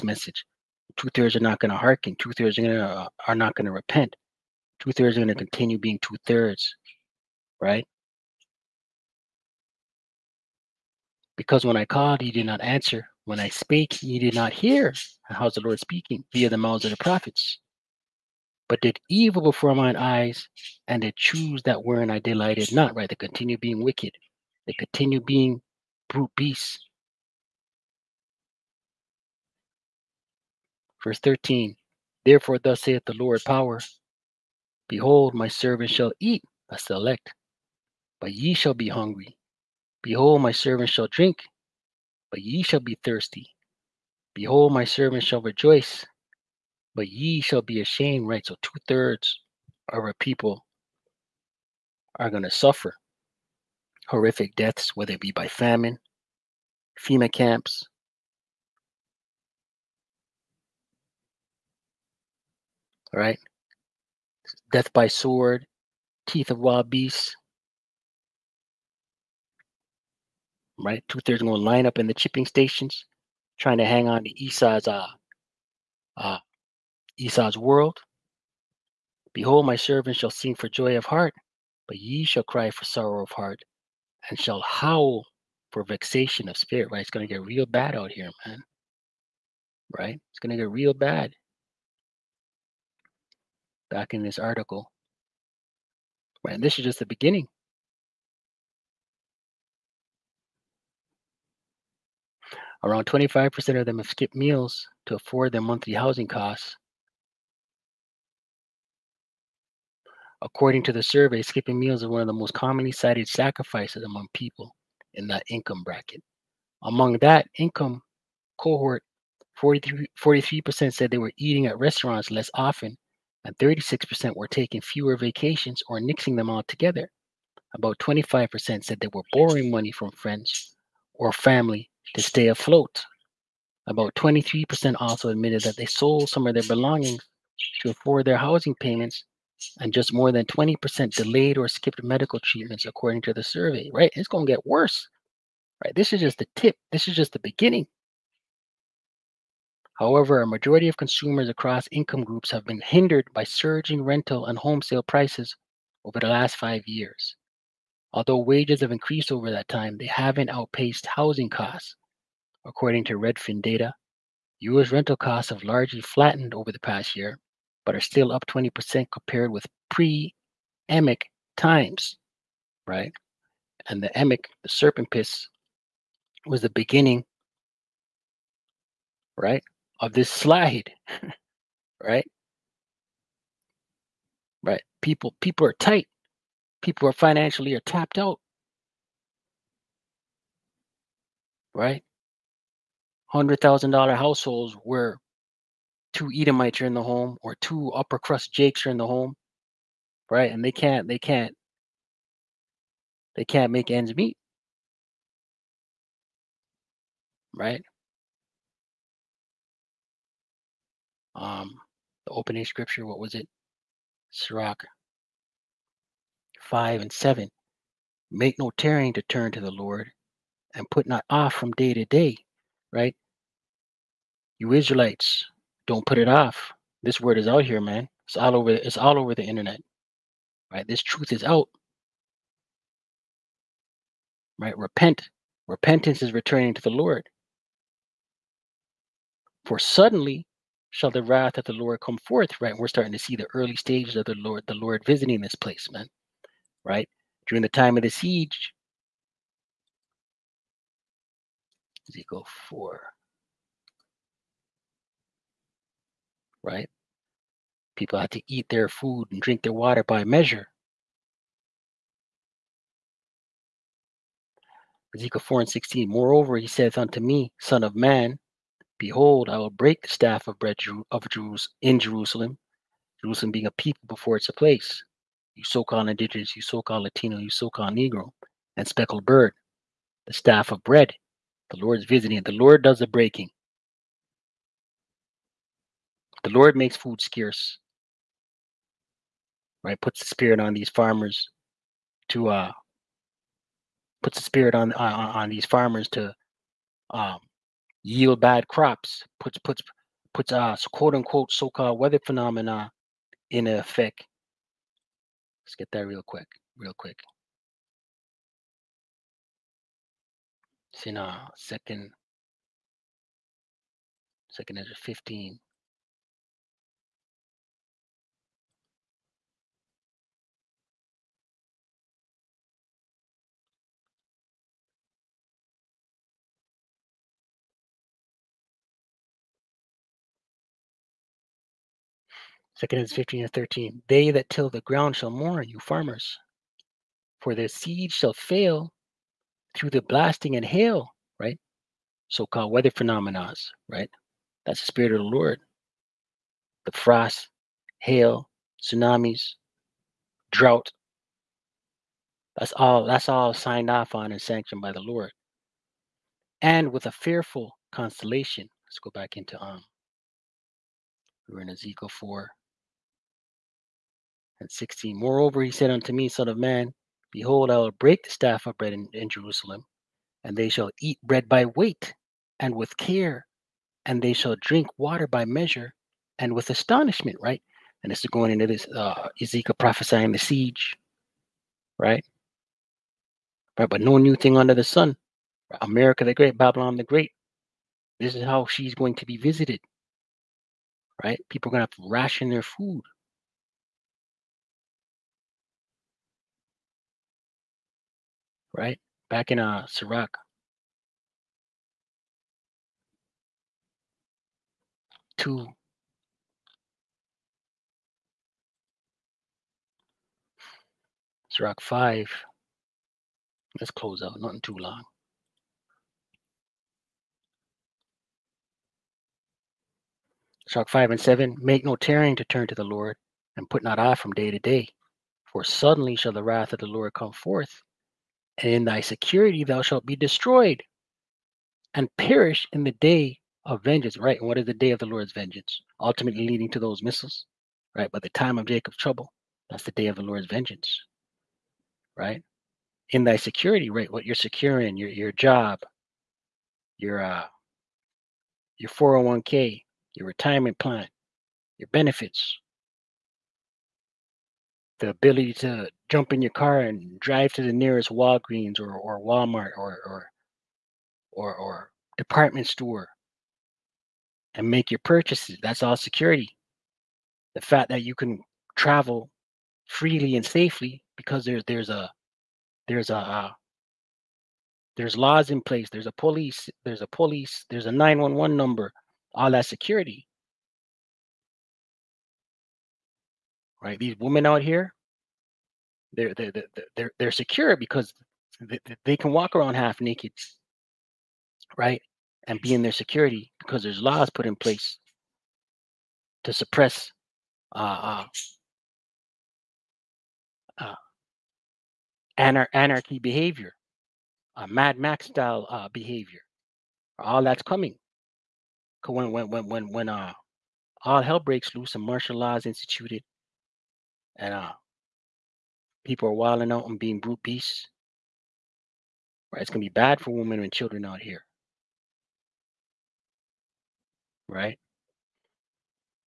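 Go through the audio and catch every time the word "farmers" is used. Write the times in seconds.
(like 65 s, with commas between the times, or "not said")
290 s, 295 s, 335 s.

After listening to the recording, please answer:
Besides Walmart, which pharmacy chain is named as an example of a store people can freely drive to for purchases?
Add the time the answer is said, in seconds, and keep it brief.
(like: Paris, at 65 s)
Walgreens, at 458 s.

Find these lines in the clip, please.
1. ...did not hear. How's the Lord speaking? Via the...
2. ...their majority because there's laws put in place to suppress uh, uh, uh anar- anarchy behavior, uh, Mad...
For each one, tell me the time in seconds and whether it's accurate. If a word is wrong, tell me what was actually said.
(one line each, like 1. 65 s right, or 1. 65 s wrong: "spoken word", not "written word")
1. 14 s right
2. 492 s wrong: "security", not "majority".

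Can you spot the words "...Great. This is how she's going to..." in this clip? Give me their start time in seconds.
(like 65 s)
387 s.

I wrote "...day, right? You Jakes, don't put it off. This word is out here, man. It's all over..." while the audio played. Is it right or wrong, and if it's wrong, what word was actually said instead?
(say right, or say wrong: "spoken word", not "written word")
wrong: "Israelites", not "Jakes".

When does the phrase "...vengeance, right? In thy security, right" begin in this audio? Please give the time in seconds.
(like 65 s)
440 s.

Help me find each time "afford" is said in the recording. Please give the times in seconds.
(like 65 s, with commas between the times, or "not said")
105 s, 137 s.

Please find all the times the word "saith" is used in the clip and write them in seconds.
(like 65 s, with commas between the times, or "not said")
32 s, 266 s.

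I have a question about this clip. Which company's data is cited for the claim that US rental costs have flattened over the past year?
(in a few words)
Redfin.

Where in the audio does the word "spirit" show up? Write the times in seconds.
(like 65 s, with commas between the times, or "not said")
86 s, 290 s, 294 s, 344 s.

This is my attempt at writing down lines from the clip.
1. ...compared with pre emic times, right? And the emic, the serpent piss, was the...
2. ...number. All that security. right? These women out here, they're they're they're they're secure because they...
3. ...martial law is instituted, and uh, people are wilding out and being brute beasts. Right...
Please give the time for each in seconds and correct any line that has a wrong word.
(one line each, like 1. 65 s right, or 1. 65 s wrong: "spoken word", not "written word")
1. 169 s right
2. 478 s right
3. 512 s right.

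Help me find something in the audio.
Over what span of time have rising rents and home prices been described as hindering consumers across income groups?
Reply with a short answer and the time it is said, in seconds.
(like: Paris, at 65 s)
5 years, at 156 s.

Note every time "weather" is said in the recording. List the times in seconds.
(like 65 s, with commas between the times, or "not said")
301 s, 342 s.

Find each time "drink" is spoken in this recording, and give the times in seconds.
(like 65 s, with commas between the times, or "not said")
41 s, 259 s, 374 s.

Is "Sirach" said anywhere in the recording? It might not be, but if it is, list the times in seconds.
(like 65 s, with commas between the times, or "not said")
214 s, 399 s, 411 s, 420 s.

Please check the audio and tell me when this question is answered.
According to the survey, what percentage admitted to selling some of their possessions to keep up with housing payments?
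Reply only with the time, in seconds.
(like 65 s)
134 s.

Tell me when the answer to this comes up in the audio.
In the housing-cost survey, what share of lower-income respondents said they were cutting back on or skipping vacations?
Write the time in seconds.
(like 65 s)
123 s.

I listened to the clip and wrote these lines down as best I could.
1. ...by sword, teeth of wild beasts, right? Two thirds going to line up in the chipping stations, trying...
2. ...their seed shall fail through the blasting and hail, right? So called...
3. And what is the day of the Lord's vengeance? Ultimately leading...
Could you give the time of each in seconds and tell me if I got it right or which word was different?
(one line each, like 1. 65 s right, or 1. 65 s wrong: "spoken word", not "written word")
1. 64 s right
2. 337 s right
3. 434 s right.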